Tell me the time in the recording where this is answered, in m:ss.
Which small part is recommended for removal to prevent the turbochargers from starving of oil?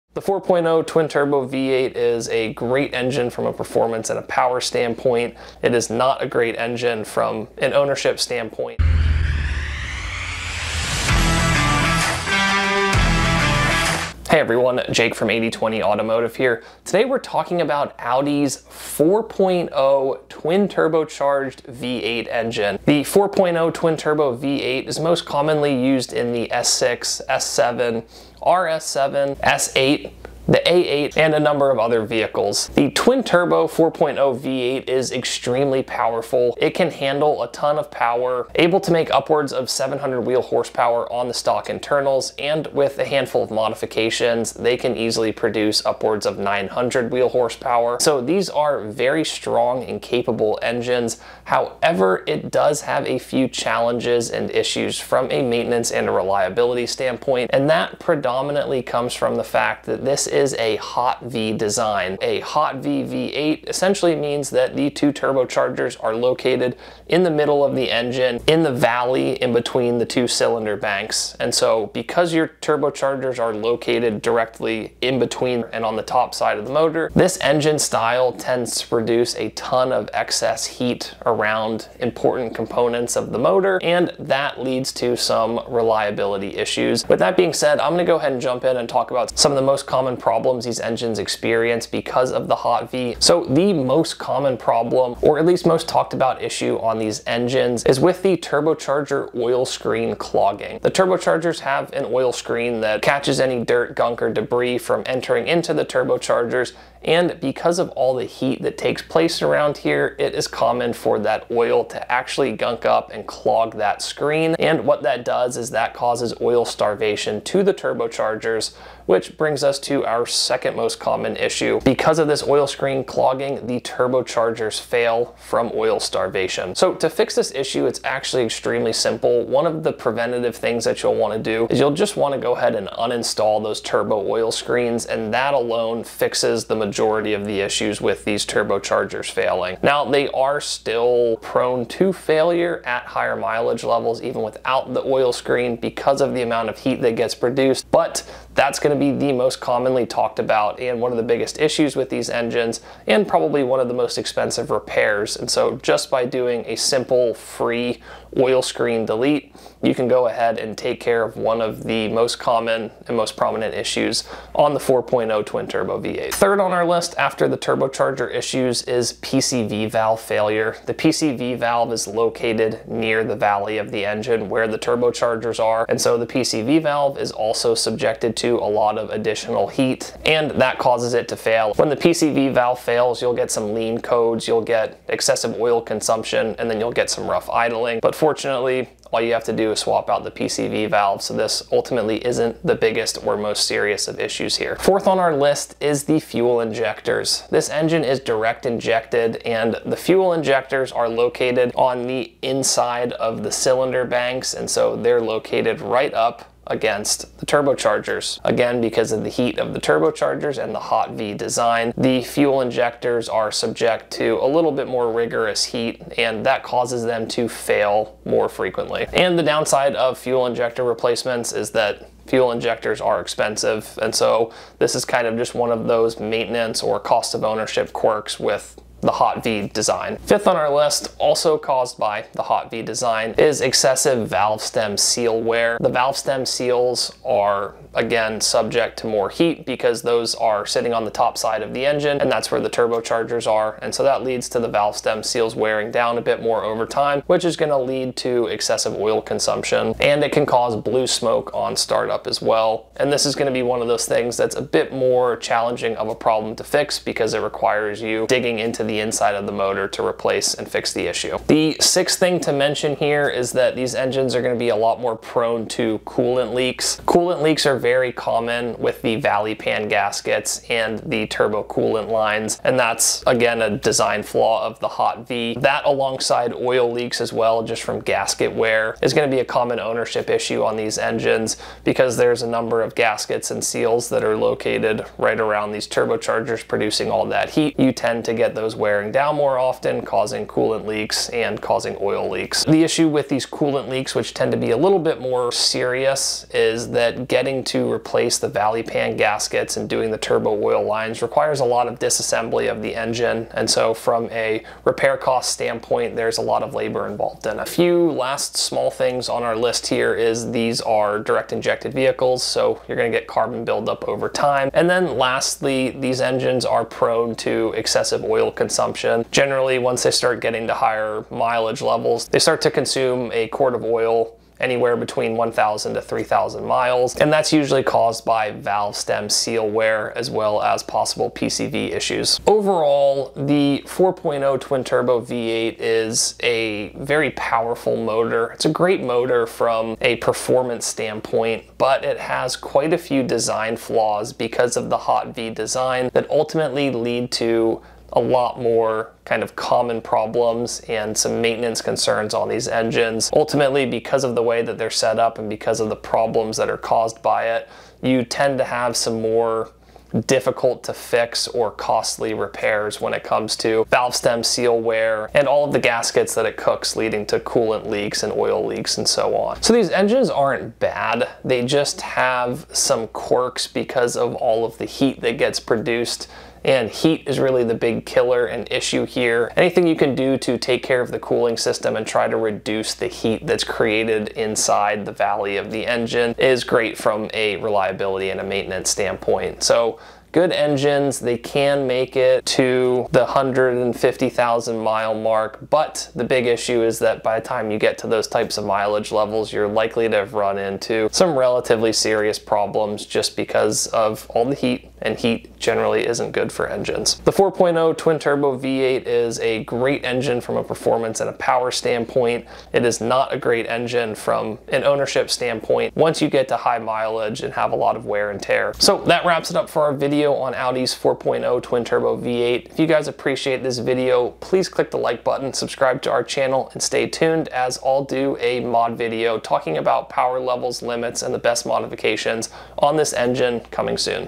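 2:13.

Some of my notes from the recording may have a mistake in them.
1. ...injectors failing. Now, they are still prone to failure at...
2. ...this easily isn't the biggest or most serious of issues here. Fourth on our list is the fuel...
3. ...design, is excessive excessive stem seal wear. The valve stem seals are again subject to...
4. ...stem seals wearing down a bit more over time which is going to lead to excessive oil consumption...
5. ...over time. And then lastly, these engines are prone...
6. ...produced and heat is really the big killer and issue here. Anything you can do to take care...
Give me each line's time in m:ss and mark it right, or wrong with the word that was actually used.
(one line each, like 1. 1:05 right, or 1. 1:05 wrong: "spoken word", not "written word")
1. 2:18 wrong: "turbochargers", not "injectors"
2. 3:11 wrong: "ultimately", not "easily"
3. 3:52 wrong: "valve", not "excessive"
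4. 4:04 right
5. 5:14 right
6. 6:15 right.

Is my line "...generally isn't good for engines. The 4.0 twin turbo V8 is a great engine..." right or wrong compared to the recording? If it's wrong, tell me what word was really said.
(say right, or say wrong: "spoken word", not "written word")
right.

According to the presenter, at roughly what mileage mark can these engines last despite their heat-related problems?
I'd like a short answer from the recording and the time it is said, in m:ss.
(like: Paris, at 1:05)
150,000 miles, at 6:33.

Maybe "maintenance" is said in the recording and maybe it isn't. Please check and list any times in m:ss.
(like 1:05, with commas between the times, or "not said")
0:55, 3:46, 5:51, 6:28.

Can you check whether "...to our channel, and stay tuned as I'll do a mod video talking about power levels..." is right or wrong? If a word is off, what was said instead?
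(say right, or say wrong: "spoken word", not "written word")
right.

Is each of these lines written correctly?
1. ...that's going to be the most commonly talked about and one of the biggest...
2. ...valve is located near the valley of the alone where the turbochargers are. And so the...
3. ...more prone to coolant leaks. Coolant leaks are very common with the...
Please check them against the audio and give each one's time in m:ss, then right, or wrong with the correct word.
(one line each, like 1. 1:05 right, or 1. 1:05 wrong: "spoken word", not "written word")
1. 2:28 right
2. 2:51 wrong: "engine", not "alone"
3. 4:24 right.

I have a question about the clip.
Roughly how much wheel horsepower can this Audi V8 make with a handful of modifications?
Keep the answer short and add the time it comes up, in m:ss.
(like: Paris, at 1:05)
900, at 0:46.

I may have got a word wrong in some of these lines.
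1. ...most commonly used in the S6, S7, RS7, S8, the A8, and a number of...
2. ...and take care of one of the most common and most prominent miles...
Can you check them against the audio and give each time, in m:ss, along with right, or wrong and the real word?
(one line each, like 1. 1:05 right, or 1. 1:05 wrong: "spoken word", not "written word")
1. 0:25 right
2. 2:40 wrong: "issues", not "miles".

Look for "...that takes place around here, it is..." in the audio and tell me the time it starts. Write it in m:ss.
1:48.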